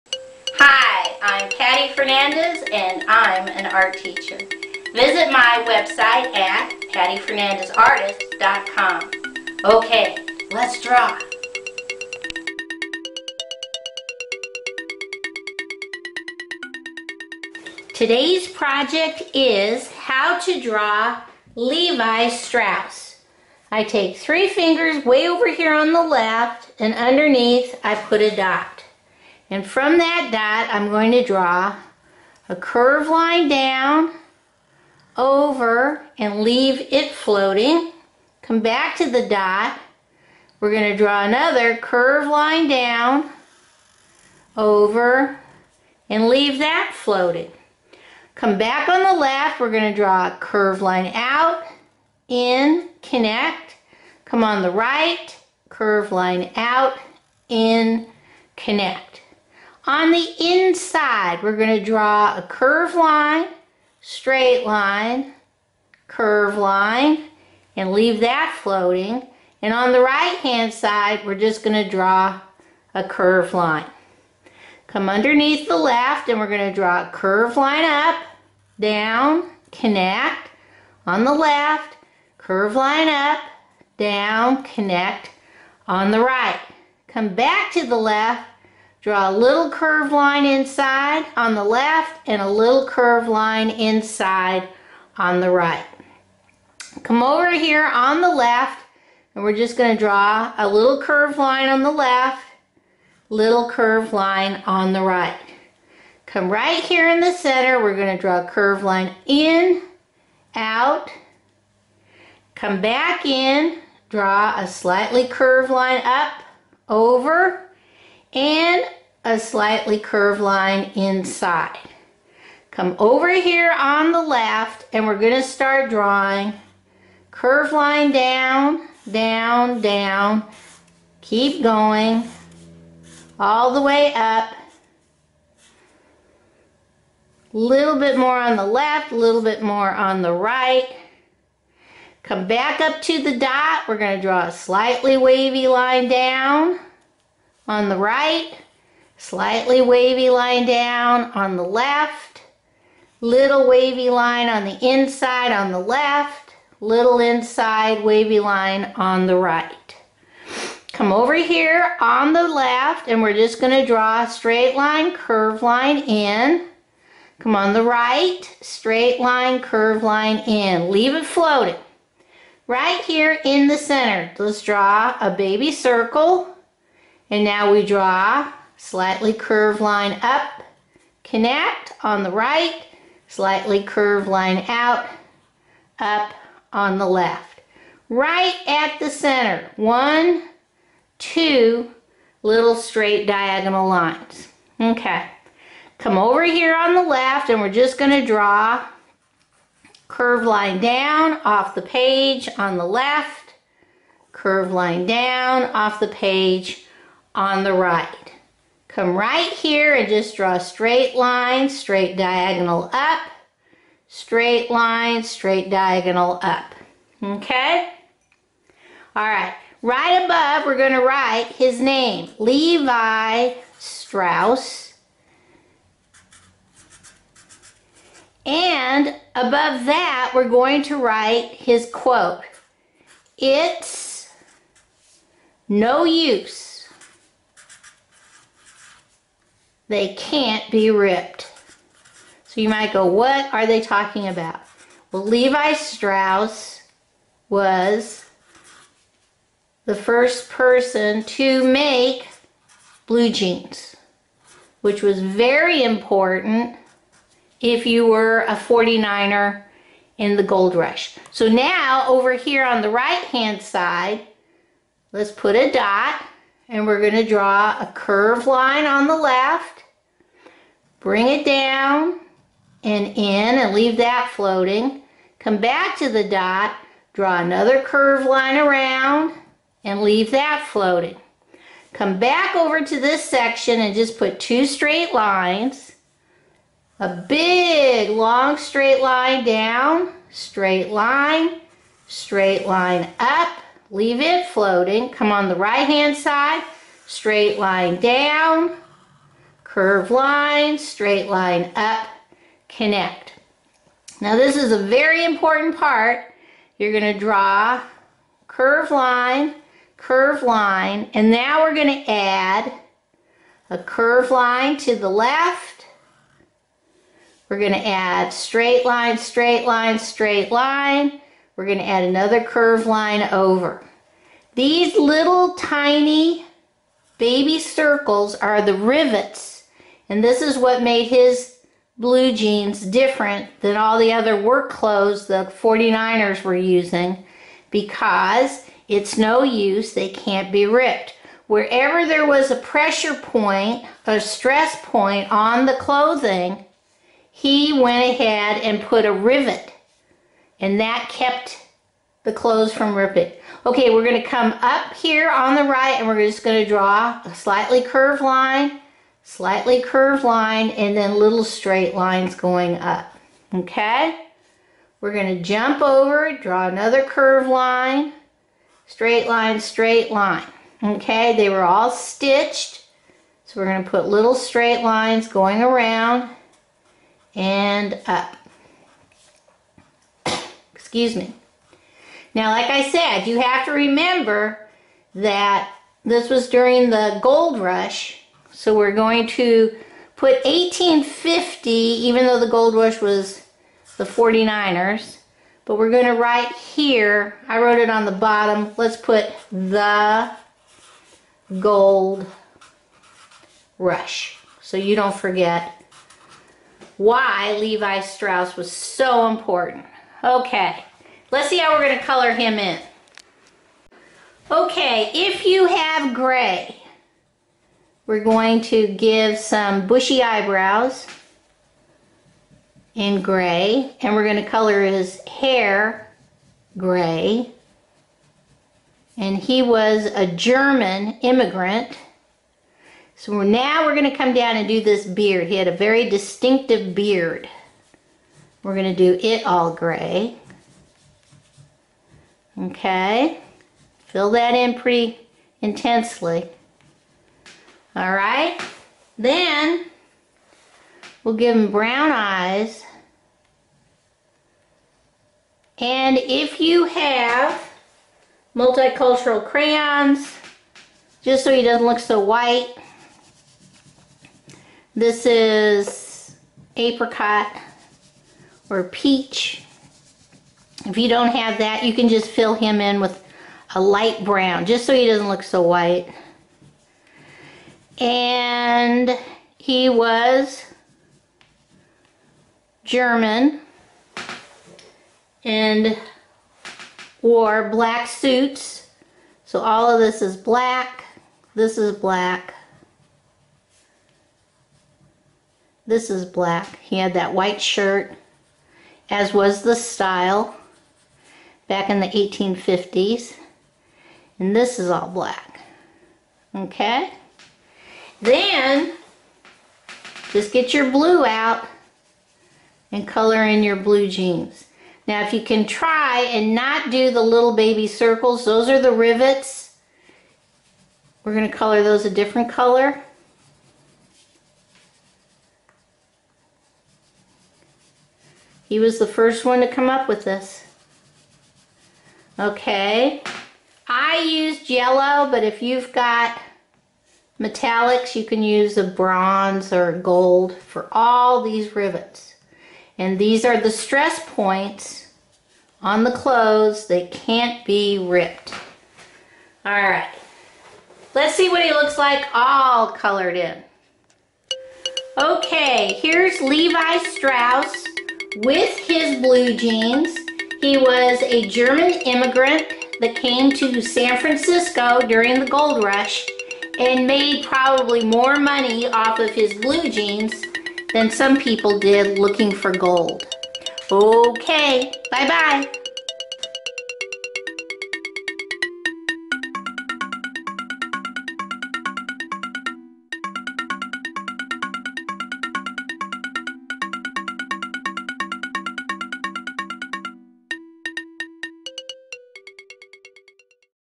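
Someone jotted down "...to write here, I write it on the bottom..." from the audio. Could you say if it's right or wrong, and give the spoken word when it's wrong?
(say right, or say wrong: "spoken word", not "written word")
wrong: "wrote", not "write".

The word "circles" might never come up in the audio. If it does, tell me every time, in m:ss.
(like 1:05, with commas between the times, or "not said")
2:55, 5:27, 8:37.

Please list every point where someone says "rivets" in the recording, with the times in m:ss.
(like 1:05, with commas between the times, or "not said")
5:28, 5:49, 8:38, 9:01.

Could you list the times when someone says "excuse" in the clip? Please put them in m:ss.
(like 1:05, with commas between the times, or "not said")
6:20.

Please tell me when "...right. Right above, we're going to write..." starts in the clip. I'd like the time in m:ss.
3:39.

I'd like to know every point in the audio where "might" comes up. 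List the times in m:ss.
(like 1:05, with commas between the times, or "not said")
4:02.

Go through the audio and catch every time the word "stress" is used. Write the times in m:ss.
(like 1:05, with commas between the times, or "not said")
5:44, 9:03.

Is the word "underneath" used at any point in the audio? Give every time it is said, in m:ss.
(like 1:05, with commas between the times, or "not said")
0:26, 1:15.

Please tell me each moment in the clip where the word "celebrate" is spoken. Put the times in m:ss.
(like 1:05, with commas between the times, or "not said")
not said.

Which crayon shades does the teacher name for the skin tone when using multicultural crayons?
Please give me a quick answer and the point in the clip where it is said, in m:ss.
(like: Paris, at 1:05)
apricot or peach, at 7:46.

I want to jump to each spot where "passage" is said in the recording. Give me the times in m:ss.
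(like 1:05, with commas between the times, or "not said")
not said.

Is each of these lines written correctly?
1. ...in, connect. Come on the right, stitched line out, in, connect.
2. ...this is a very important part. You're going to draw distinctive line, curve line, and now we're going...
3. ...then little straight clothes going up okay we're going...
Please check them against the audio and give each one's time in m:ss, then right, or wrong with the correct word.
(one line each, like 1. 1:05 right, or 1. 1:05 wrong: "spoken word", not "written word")
1. 0:52 wrong: "curved", not "stitched"
2. 5:04 wrong: "curve", not "distinctive"
3. 6:00 wrong: "lines", not "clothes".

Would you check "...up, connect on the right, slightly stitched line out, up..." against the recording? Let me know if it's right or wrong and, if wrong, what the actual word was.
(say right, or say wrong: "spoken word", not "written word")
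wrong: "curved", not "stitched".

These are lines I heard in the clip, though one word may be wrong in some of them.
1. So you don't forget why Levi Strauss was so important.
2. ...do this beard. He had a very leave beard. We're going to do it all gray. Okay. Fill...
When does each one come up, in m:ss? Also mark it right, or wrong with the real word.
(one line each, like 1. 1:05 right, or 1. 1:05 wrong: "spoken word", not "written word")
1. 6:44 right
2. 7:14 wrong: "distinctive", not "leave".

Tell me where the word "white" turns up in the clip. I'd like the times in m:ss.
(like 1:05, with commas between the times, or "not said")
7:42, 7:55, 8:17.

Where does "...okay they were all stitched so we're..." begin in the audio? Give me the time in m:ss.
6:10.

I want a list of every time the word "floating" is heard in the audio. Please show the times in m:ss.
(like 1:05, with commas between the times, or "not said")
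0:37, 0:46, 1:08, 2:51, 4:34, 4:40, 4:54.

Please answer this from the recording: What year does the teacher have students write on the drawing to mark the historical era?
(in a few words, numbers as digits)
1850.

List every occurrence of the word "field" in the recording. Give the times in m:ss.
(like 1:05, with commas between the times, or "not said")
not said.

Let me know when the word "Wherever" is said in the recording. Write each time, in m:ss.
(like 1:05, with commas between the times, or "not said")
5:41.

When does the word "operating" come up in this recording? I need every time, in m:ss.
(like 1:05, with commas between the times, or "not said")
not said.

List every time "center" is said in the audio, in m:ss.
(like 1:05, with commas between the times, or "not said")
1:47, 2:53, 3:09.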